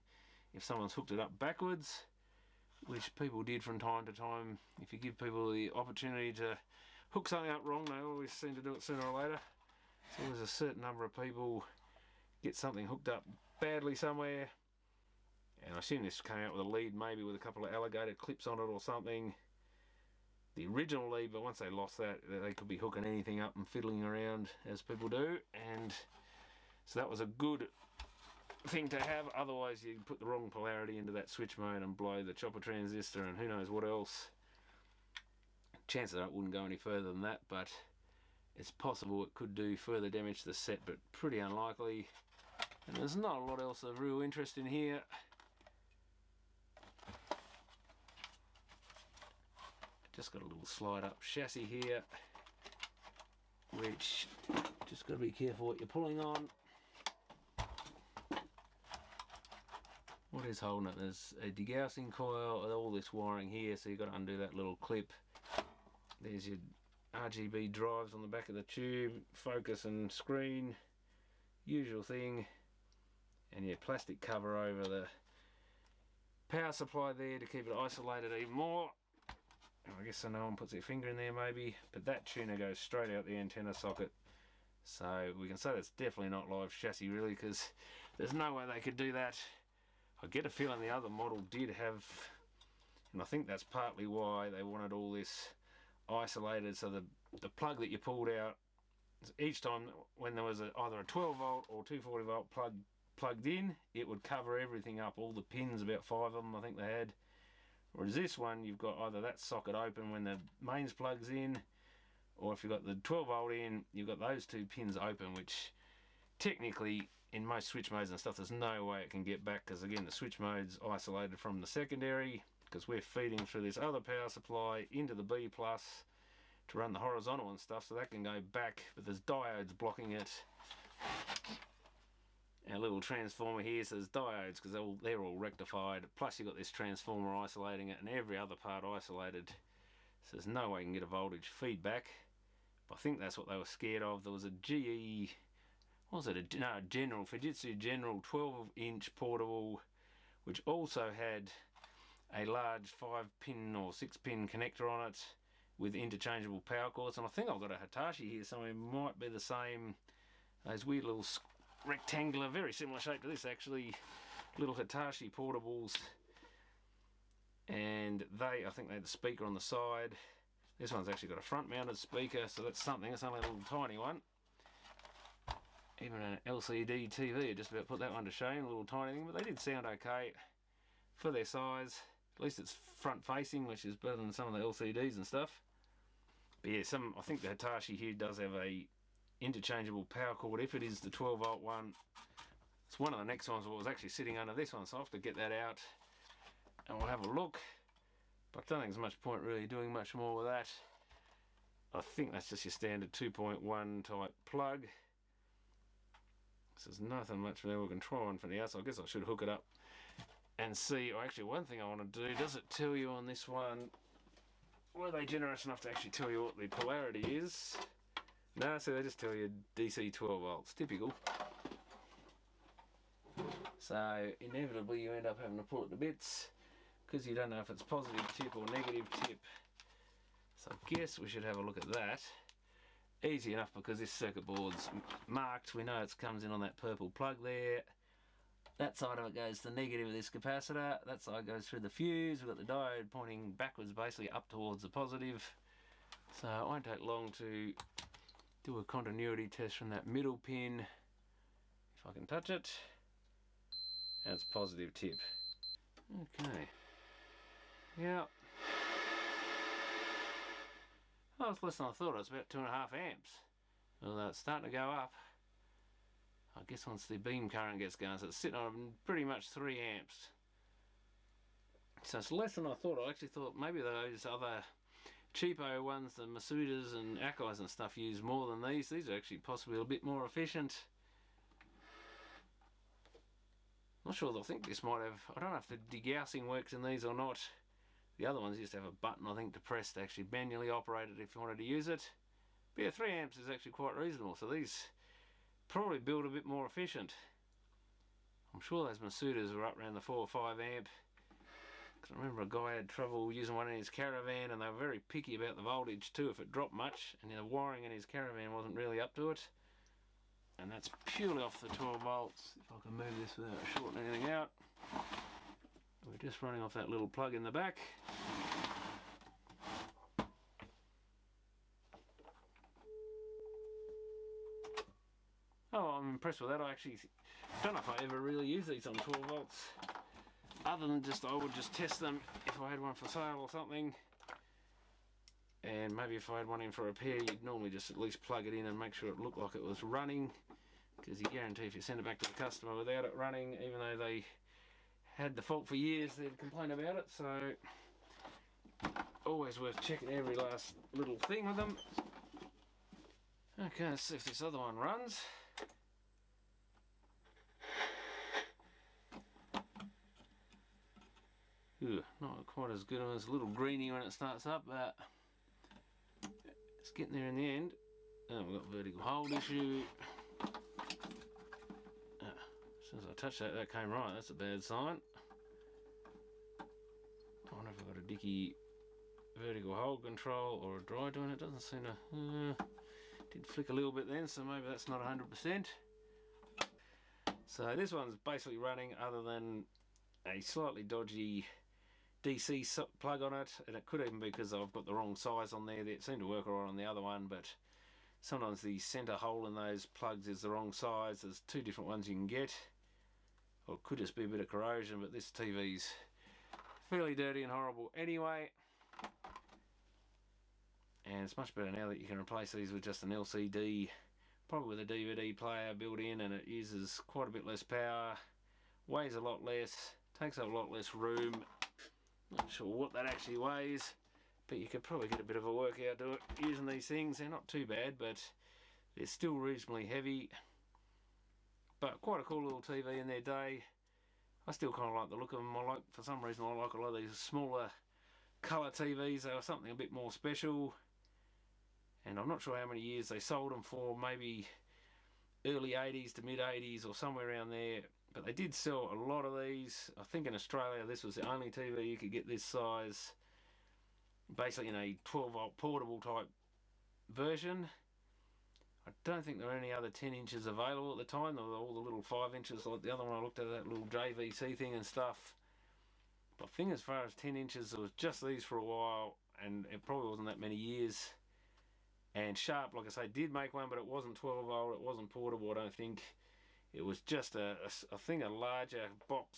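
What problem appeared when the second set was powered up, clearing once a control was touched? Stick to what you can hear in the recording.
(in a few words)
vertical hold issue.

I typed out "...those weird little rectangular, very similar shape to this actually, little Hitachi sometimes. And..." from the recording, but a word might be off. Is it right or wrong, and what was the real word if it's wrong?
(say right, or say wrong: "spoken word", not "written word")
wrong: "portables", not "sometimes".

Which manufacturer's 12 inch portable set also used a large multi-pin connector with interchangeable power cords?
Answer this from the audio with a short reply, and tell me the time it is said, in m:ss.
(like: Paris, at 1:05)
Fujitsu General, at 2:27.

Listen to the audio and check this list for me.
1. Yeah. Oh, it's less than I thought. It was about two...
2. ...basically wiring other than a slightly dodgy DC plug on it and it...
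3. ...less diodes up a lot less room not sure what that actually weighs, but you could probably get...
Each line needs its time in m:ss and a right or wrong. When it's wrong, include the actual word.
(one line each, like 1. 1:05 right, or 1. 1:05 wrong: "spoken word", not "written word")
1. 4:17 right
2. 6:28 wrong: "running", not "wiring"
3. 6:59 wrong: "takes", not "diodes".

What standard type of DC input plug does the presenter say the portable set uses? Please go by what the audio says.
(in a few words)
2.1.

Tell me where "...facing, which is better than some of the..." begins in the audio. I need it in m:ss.
3:03.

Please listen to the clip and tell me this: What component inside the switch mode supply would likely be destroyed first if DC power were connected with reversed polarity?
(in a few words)
chopper transistor.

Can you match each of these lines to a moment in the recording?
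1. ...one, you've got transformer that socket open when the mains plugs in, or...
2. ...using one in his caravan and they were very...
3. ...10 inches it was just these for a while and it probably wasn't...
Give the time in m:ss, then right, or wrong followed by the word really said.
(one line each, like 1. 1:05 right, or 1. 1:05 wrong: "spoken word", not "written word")
1. 1:48 wrong: "either", not "transformer"
2. 5:03 right
3. 7:47 right.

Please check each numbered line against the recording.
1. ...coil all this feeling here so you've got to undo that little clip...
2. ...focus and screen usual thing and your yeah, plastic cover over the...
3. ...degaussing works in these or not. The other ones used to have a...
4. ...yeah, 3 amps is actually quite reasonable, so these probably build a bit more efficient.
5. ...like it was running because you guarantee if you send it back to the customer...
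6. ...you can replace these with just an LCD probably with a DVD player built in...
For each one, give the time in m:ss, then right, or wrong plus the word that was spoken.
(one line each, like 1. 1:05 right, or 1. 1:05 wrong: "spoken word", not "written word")
1. 1:02 wrong: "wiring", not "feeling"
2. 1:09 right
3. 4:45 right
4. 4:52 right
5. 5:39 right
6. 6:51 right.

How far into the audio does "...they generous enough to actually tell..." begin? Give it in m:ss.
3:35.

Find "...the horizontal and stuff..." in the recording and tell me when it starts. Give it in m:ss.
2:06.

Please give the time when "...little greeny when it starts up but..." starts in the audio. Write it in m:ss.
6:03.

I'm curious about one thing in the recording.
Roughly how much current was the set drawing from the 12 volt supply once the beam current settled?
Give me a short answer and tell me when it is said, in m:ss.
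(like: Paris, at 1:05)
3 amps, at 4:29.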